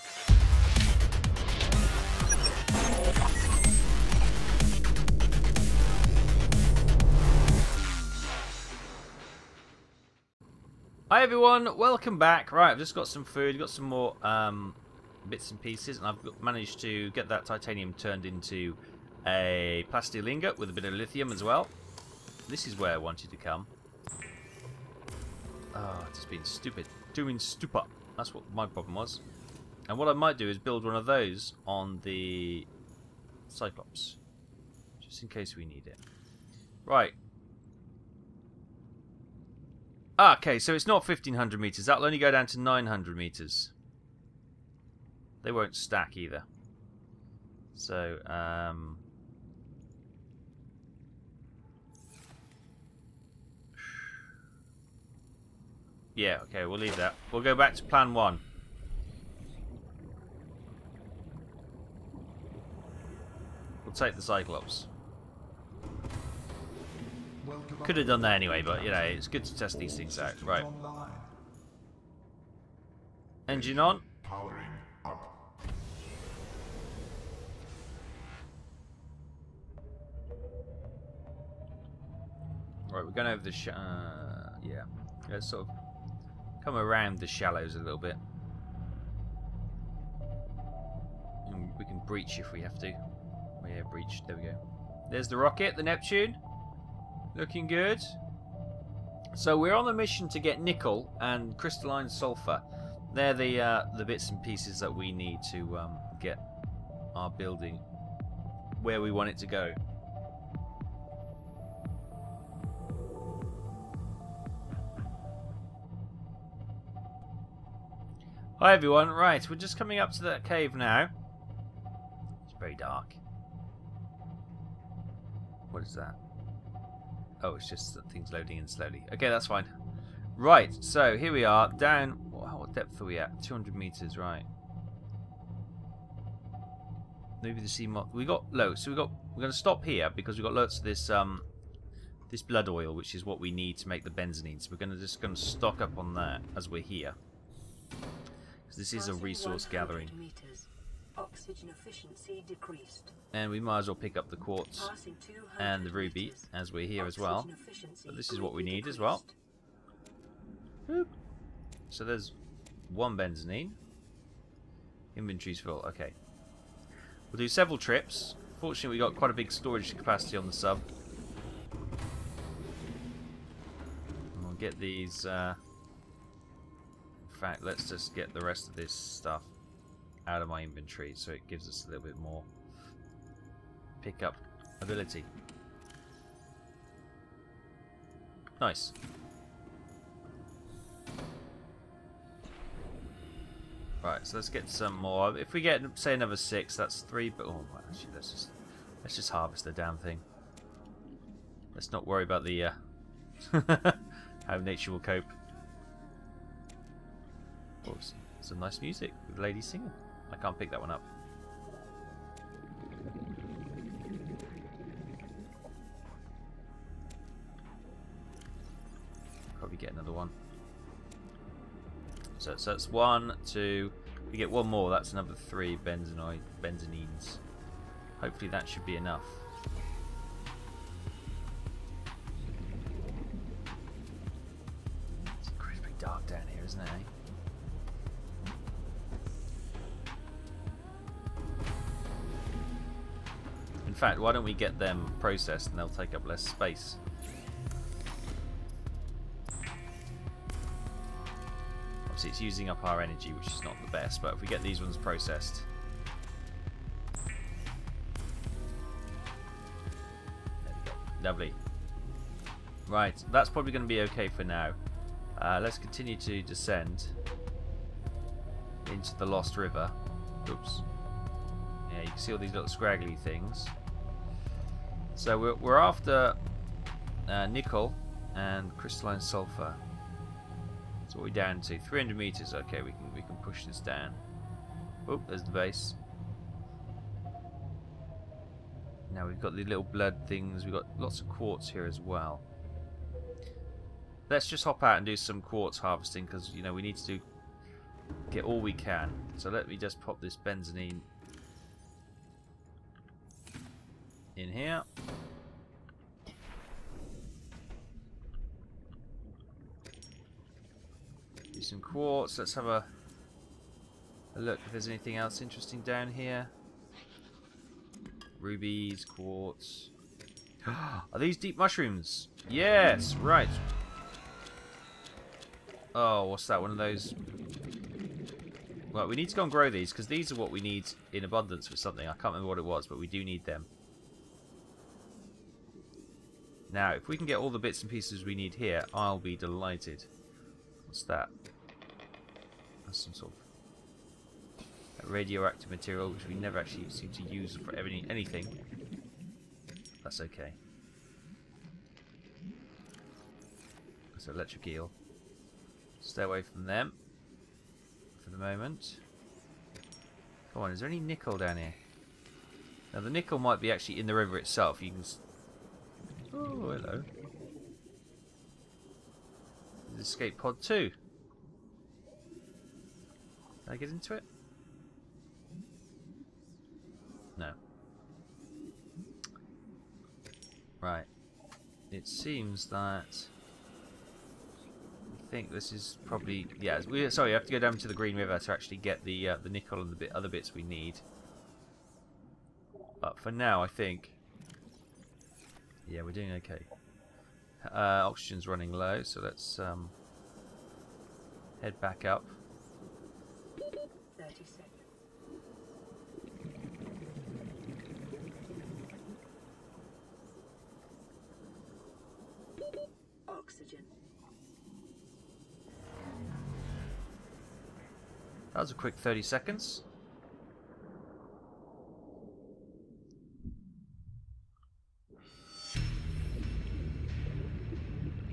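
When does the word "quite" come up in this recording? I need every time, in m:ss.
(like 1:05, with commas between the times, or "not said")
2:49.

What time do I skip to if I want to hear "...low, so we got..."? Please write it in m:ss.
2:18.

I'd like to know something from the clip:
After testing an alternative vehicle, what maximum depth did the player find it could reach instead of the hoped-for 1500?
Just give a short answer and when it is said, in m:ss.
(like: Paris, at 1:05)
900 metres, at 0:42.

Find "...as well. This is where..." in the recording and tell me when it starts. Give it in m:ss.
0:21.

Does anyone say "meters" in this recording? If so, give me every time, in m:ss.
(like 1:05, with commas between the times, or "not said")
2:30, 4:42.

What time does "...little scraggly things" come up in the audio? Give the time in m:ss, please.
4:32.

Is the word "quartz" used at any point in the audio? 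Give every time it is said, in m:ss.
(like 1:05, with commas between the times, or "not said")
2:34, 4:51, 4:55, 5:11, 5:19.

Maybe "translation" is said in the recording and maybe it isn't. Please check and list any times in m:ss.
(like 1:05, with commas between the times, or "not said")
not said.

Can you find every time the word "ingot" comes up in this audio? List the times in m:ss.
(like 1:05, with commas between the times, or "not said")
0:20.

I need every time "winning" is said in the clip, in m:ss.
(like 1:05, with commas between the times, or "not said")
not said.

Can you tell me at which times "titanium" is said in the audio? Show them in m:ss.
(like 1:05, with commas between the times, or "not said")
0:17.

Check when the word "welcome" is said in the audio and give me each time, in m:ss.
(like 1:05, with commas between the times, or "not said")
0:11.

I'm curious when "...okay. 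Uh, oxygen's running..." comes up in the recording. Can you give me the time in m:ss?
6:36.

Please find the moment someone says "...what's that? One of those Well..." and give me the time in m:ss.
5:26.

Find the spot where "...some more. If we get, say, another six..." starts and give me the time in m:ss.
3:14.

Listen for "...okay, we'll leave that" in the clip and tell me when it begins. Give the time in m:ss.
0:56.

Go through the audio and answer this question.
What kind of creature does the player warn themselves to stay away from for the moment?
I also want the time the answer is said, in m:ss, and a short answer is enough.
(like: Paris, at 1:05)
electric eel, at 5:54.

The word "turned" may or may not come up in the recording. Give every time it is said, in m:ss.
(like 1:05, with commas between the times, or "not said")
0:17.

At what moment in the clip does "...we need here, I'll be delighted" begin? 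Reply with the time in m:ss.
5:38.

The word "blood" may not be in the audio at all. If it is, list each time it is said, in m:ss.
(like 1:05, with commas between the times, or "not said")
2:22, 4:49.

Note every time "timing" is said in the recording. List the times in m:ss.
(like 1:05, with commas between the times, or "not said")
not said.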